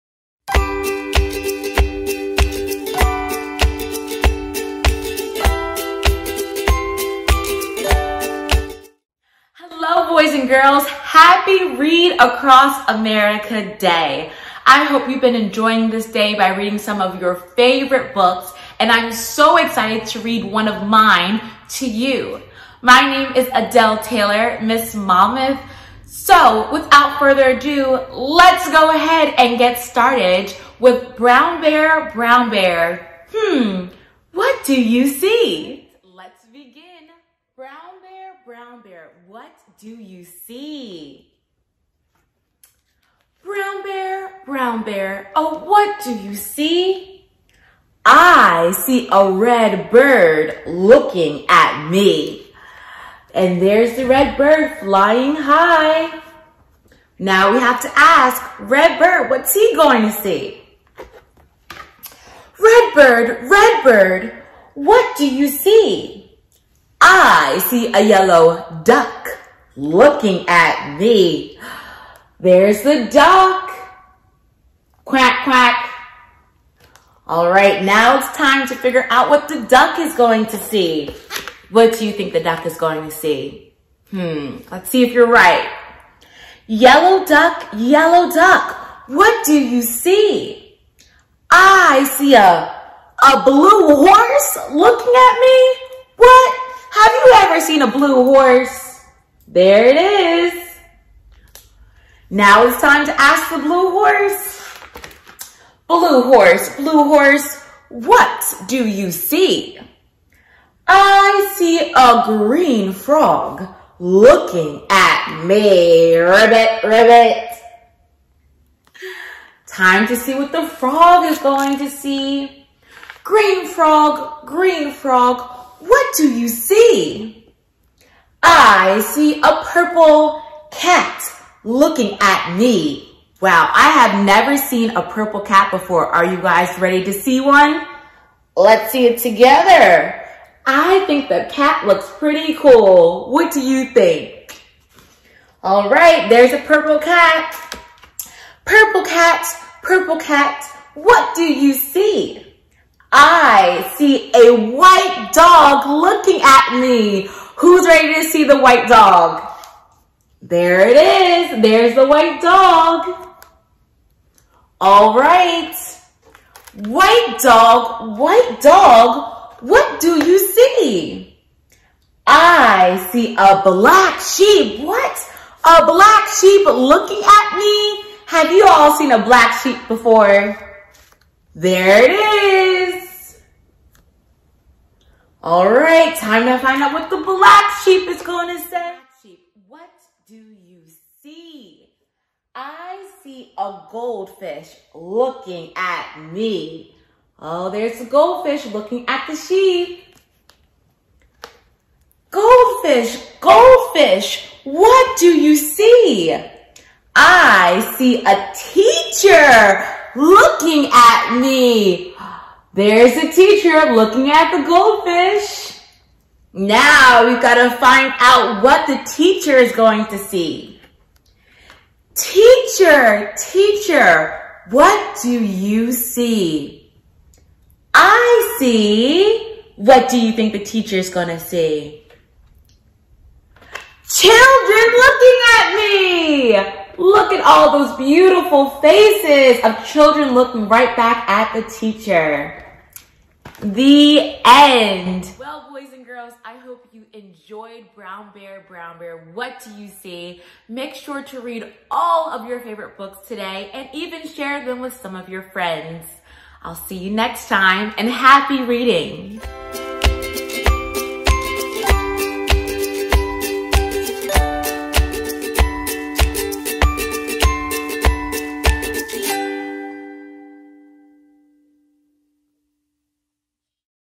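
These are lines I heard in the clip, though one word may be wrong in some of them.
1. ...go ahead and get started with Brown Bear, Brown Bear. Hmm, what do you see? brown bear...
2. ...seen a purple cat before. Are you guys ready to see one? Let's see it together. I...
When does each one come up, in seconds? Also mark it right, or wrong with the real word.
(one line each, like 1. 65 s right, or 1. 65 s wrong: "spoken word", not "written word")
1. 28 s right
2. 134 s right.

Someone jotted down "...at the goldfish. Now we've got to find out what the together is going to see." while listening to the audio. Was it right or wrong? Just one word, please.
wrong.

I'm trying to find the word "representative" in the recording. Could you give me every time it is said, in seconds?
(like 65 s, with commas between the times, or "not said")
not said.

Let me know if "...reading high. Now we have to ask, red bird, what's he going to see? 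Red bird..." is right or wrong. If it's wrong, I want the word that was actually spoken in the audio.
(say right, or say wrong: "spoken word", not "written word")
wrong: "flying", not "reading".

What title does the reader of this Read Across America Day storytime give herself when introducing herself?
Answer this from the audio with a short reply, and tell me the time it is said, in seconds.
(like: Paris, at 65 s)
Miss Monmouth, at 24 s.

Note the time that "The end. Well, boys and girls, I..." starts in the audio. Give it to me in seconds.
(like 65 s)
243 s.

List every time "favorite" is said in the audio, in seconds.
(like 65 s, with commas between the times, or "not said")
17 s, 252 s.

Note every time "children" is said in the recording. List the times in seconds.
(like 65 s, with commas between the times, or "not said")
234 s, 239 s.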